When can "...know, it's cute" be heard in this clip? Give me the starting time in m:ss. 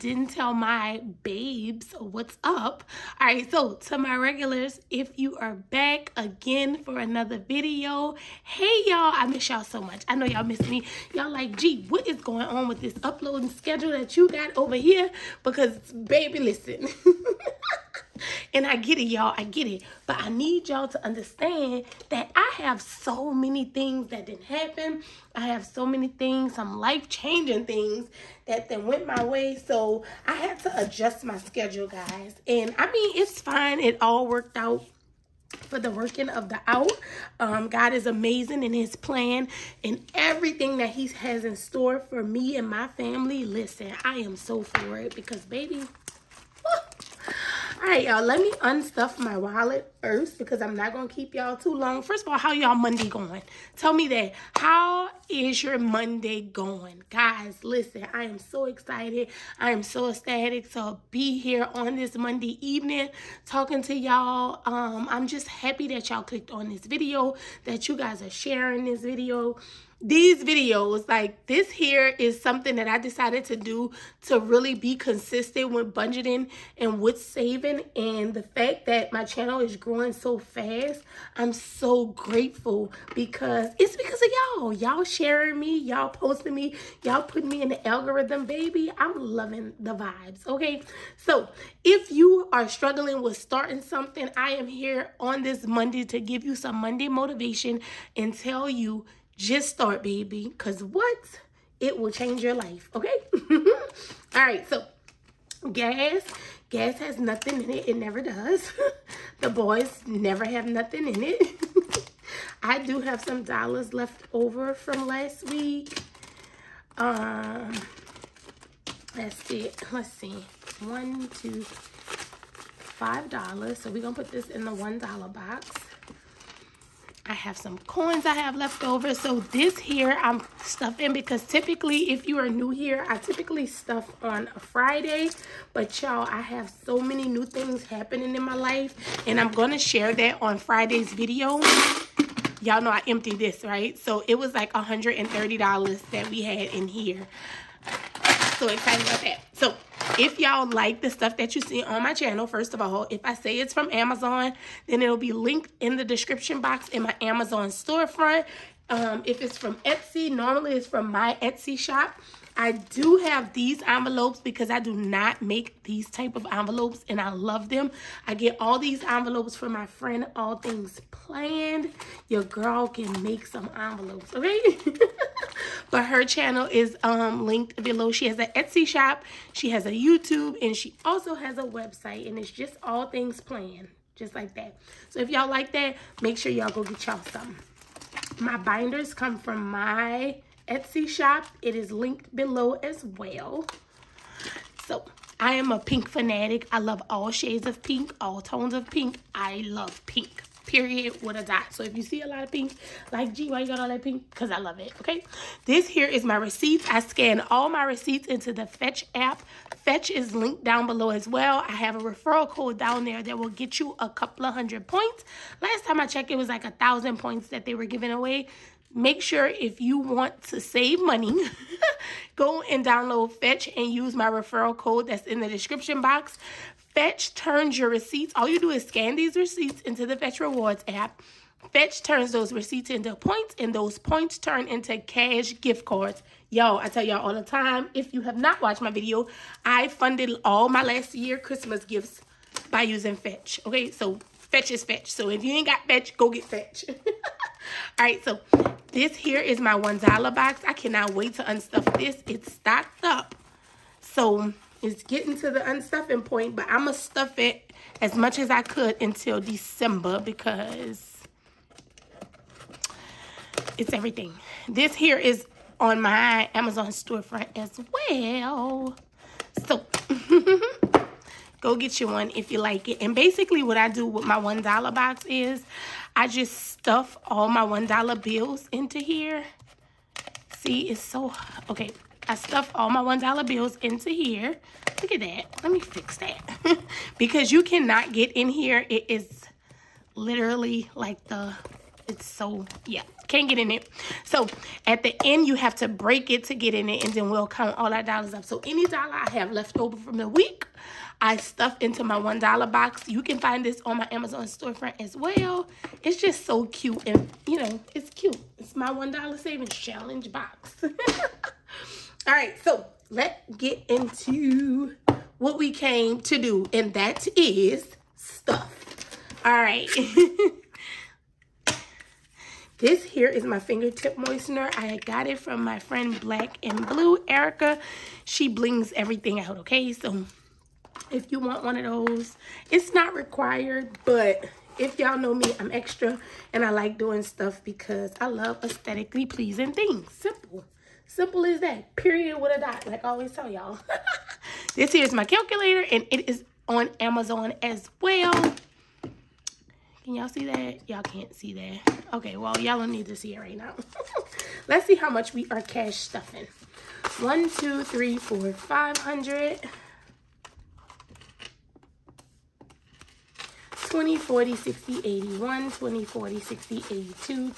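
5:07.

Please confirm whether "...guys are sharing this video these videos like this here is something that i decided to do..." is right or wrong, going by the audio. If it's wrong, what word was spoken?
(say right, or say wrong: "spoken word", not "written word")
right.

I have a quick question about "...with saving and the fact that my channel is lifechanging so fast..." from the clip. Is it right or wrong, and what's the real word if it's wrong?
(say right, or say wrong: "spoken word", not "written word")
wrong: "growing", not "lifechanging".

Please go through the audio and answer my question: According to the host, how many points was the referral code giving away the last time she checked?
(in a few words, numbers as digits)
1000.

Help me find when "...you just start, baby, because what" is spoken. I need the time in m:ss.
1:38.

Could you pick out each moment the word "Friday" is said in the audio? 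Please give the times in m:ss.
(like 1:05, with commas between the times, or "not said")
2:14, 2:20.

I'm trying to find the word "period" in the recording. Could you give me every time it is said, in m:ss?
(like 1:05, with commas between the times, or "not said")
3:20, 5:41.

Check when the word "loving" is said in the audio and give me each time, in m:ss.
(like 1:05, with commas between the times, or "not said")
1:29.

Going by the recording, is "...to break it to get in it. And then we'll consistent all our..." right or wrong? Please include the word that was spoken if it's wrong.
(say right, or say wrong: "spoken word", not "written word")
wrong: "count", not "consistent".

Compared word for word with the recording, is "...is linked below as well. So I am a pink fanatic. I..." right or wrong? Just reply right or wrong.
right.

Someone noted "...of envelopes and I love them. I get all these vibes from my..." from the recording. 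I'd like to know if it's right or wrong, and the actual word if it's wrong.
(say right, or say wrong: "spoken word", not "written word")
wrong: "envelopes", not "vibes".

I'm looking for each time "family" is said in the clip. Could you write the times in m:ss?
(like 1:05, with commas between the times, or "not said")
0:42.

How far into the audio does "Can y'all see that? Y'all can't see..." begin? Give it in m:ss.
5:50.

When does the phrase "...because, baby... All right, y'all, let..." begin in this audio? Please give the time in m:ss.
0:45.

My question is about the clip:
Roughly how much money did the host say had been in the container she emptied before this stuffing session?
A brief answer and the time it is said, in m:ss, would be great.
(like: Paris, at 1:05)
$130, at 2:24.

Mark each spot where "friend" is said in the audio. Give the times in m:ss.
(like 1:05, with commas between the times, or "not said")
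2:49, 5:25.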